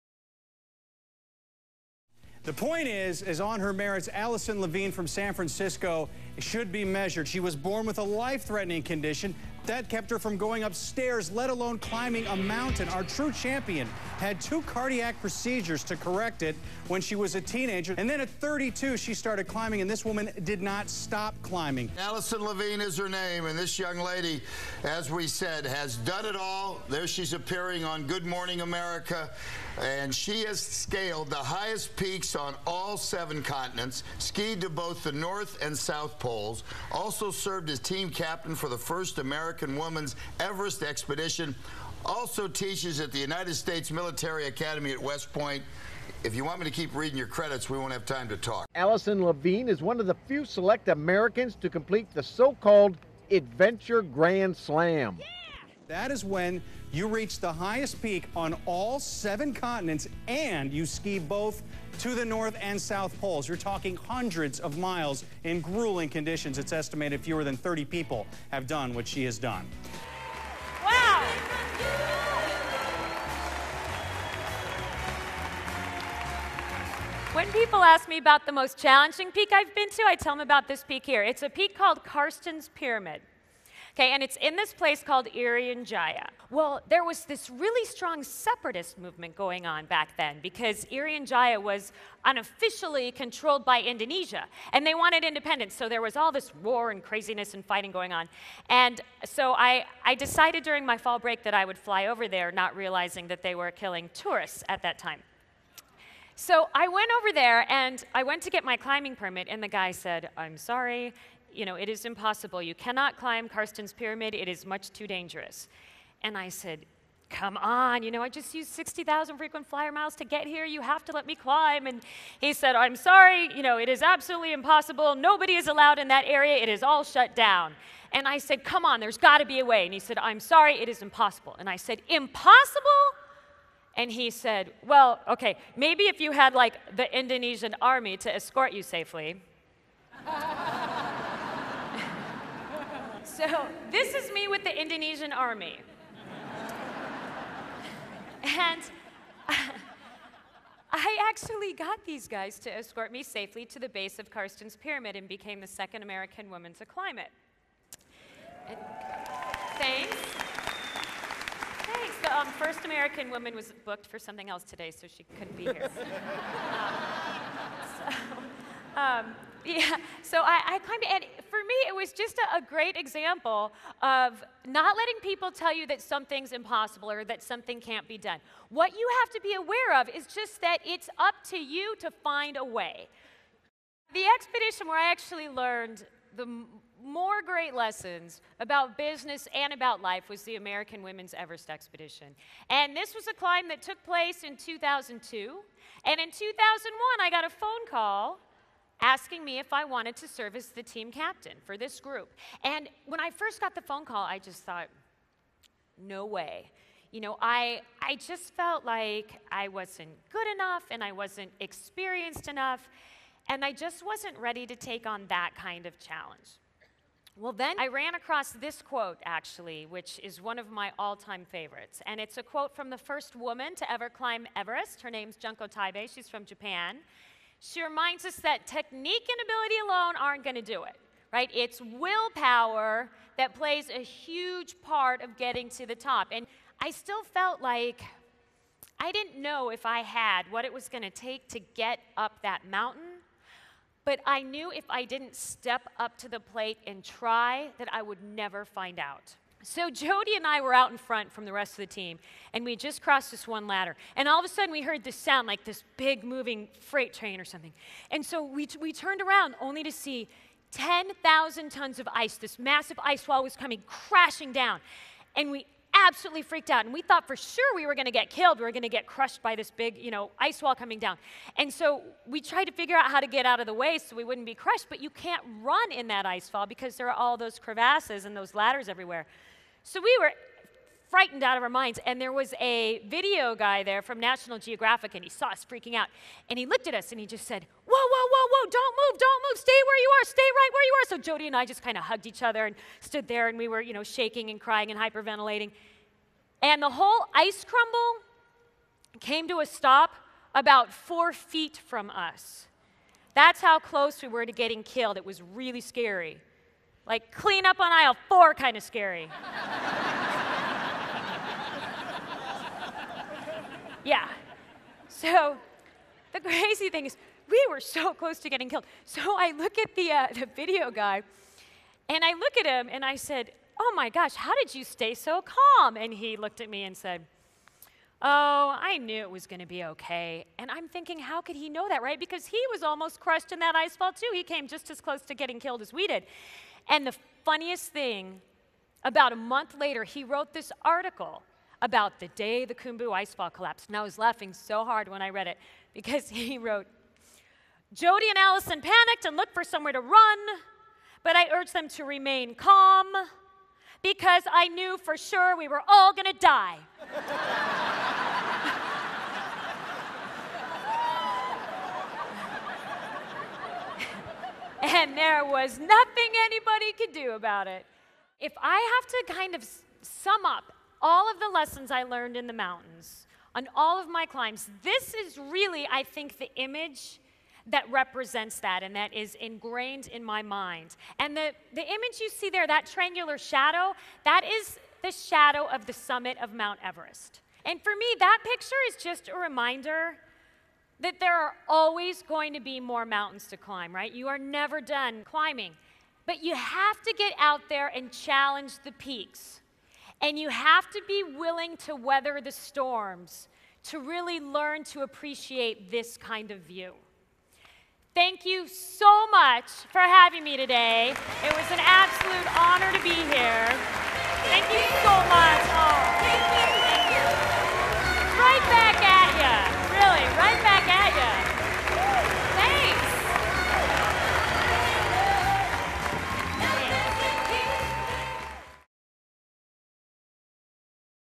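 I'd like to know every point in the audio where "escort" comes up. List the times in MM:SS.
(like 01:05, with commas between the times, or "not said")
02:18, 02:32.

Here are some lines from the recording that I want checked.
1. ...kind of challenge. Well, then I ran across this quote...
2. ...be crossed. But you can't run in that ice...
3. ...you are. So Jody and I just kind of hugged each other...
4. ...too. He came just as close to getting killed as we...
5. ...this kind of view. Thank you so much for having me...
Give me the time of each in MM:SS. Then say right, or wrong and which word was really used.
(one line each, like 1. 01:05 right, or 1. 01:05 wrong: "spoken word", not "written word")
1. 03:35 right
2. 04:34 wrong: "crushed", not "crossed"
3. 04:50 right
4. 05:34 right
5. 06:45 right.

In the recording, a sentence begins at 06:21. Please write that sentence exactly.
And the, the image you see there, that triangular shadow, that is the shadow of the summit of Mount Everest.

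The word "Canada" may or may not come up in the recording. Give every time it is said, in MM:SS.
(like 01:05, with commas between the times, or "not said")
not said.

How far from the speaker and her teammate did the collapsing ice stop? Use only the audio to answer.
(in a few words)
about four feet.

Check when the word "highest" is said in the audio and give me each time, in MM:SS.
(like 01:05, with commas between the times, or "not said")
00:31, 00:57.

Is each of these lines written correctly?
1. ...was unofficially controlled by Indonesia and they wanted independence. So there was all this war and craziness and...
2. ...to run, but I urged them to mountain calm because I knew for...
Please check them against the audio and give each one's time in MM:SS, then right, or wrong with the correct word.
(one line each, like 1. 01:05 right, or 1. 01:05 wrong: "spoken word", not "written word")
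1. 01:31 right
2. 05:49 wrong: "remain", not "mountain".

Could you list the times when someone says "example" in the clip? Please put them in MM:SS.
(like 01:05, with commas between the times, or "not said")
02:52.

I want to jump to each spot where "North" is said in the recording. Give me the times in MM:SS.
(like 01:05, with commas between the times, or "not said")
00:35, 01:02.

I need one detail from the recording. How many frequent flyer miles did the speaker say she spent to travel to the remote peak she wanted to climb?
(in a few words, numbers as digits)
60,000.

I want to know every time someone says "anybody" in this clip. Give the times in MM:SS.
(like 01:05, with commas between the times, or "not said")
06:06.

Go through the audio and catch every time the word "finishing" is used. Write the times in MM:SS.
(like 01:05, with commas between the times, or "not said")
not said.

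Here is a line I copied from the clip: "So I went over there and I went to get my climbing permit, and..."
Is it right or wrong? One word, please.
right.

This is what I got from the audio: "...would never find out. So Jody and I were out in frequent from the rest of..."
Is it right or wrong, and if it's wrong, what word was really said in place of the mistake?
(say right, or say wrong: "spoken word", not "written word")
wrong: "front", not "frequent".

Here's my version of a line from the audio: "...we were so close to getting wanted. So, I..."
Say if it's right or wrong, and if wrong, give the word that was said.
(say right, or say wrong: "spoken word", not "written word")
wrong: "killed", not "wanted".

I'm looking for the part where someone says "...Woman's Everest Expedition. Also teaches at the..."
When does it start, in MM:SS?
00:39.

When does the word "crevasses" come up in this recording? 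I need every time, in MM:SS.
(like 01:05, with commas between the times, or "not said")
04:37.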